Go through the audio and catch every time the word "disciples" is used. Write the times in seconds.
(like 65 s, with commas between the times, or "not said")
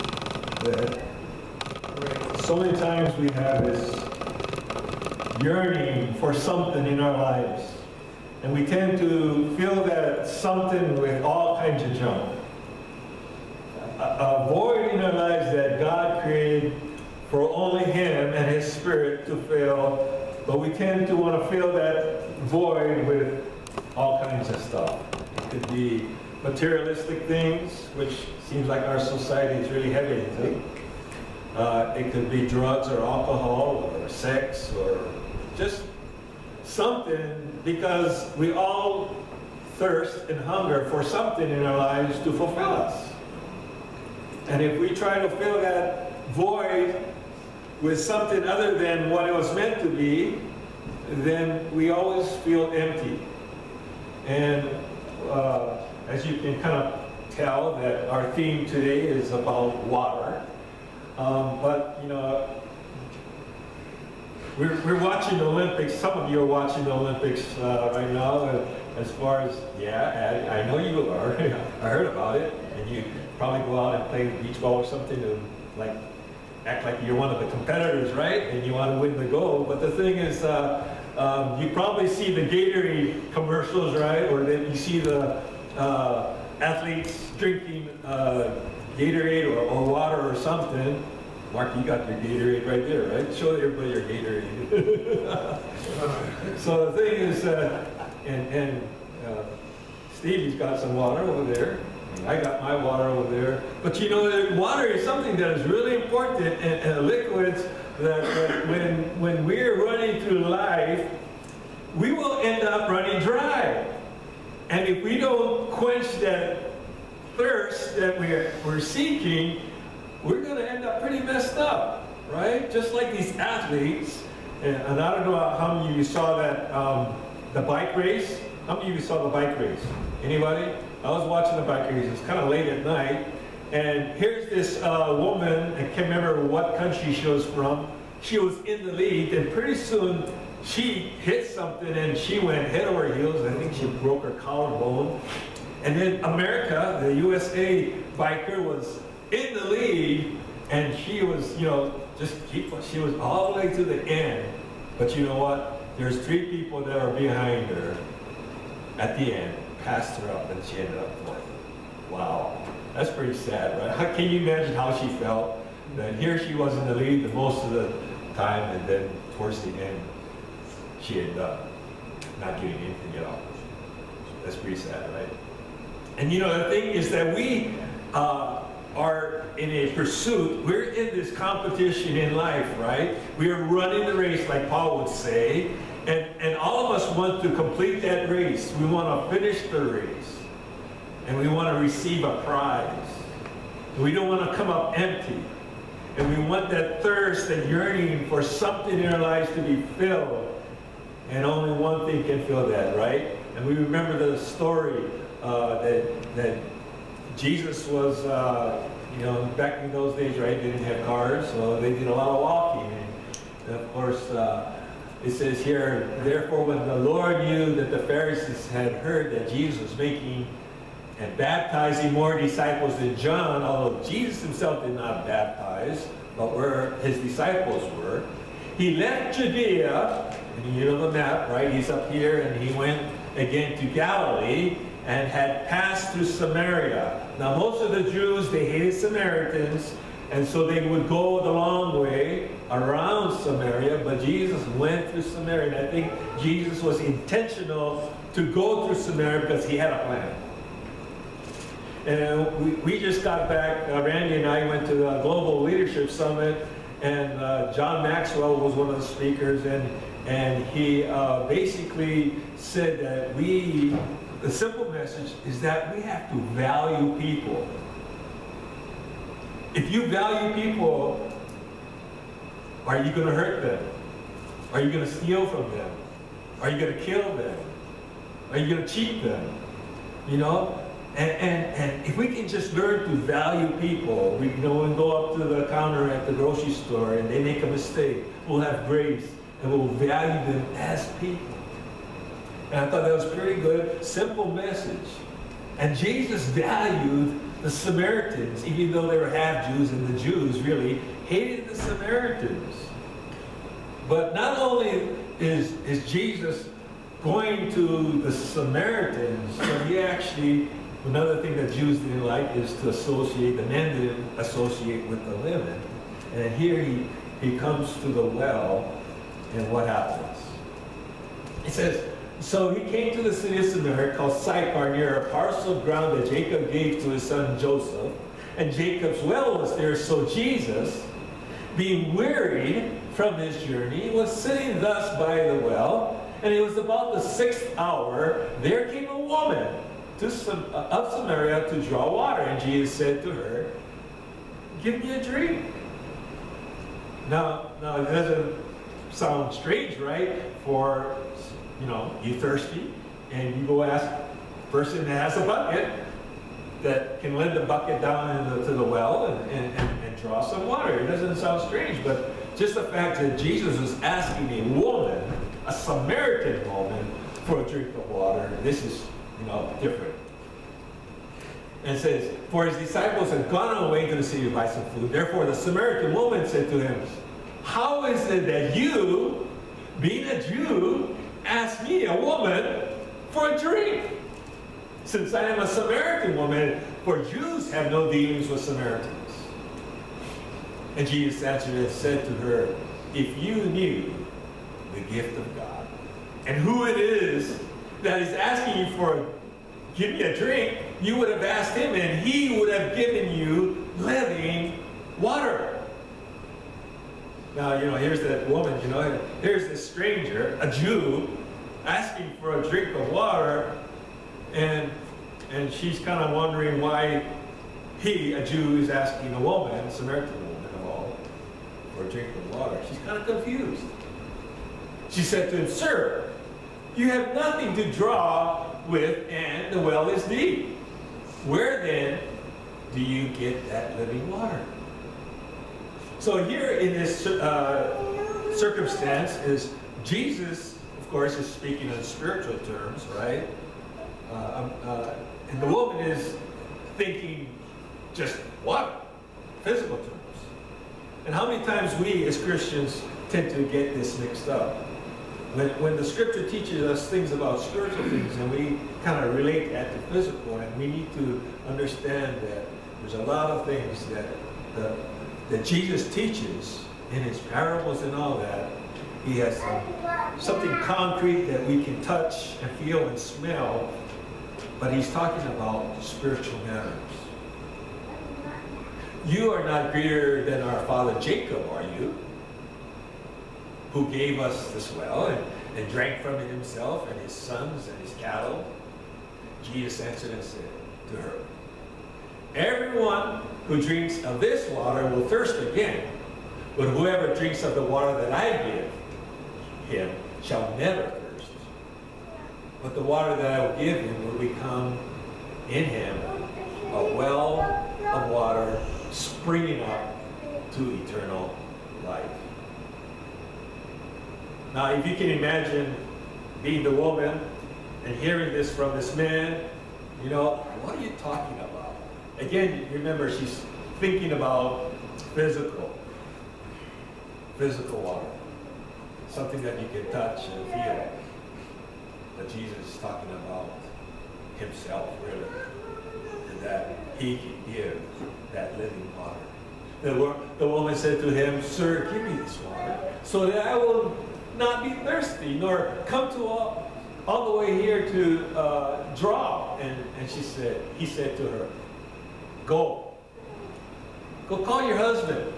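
222 s, 227 s, 372 s.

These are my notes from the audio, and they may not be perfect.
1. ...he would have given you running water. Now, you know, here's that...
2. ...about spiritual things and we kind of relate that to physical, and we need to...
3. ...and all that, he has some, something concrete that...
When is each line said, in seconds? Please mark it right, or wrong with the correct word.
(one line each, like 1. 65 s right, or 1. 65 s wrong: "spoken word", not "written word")
1. 402 s wrong: "living", not "running"
2. 457 s right
3. 468 s right.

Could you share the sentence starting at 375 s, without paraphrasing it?
Therefore the Samaritan woman said to him, how is it that you, being a Jew, ask me, a woman, for a drink?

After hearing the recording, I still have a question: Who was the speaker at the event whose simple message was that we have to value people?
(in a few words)
John Maxwell.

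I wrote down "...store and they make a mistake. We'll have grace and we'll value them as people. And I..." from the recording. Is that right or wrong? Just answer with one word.
right.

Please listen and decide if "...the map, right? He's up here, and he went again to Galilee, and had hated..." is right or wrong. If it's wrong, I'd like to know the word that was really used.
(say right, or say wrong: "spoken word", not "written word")
wrong: "passed", not "hated".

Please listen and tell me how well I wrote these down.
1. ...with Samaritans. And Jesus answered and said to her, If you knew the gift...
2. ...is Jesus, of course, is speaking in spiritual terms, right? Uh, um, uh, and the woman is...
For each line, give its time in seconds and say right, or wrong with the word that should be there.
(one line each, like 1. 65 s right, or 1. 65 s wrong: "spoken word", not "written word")
1. 388 s right
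2. 439 s right.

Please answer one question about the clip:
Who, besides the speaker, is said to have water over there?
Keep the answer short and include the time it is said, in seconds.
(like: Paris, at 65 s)
Stevie, at 100 s.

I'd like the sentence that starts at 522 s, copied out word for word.
again, remember she's thinking about physical, physical water, something that you can touch and feel.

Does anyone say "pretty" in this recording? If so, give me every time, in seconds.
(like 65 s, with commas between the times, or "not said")
121 s, 139 s, 163 s, 174 s, 293 s.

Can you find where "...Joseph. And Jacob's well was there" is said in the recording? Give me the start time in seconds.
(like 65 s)
327 s.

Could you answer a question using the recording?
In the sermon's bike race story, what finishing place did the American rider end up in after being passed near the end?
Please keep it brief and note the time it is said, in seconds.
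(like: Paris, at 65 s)
fourth, at 160 s.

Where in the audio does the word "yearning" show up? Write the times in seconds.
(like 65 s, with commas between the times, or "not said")
5 s, 197 s.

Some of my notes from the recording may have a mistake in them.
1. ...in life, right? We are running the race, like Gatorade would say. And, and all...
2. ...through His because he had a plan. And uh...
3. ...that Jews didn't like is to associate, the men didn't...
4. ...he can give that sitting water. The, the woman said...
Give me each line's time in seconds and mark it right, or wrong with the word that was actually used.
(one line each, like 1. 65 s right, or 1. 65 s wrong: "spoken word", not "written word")
1. 182 s wrong: "Paul", not "Gatorade"
2. 248 s wrong: "Samaria", not "His"
3. 311 s right
4. 537 s wrong: "living", not "sitting".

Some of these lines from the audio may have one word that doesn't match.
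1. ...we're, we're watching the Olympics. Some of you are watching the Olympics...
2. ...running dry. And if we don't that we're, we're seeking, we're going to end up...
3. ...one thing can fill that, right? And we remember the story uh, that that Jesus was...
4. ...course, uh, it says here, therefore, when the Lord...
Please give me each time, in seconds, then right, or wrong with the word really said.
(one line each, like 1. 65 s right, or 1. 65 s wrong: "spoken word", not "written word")
1. 64 s right
2. 112 s right
3. 201 s right
4. 213 s right.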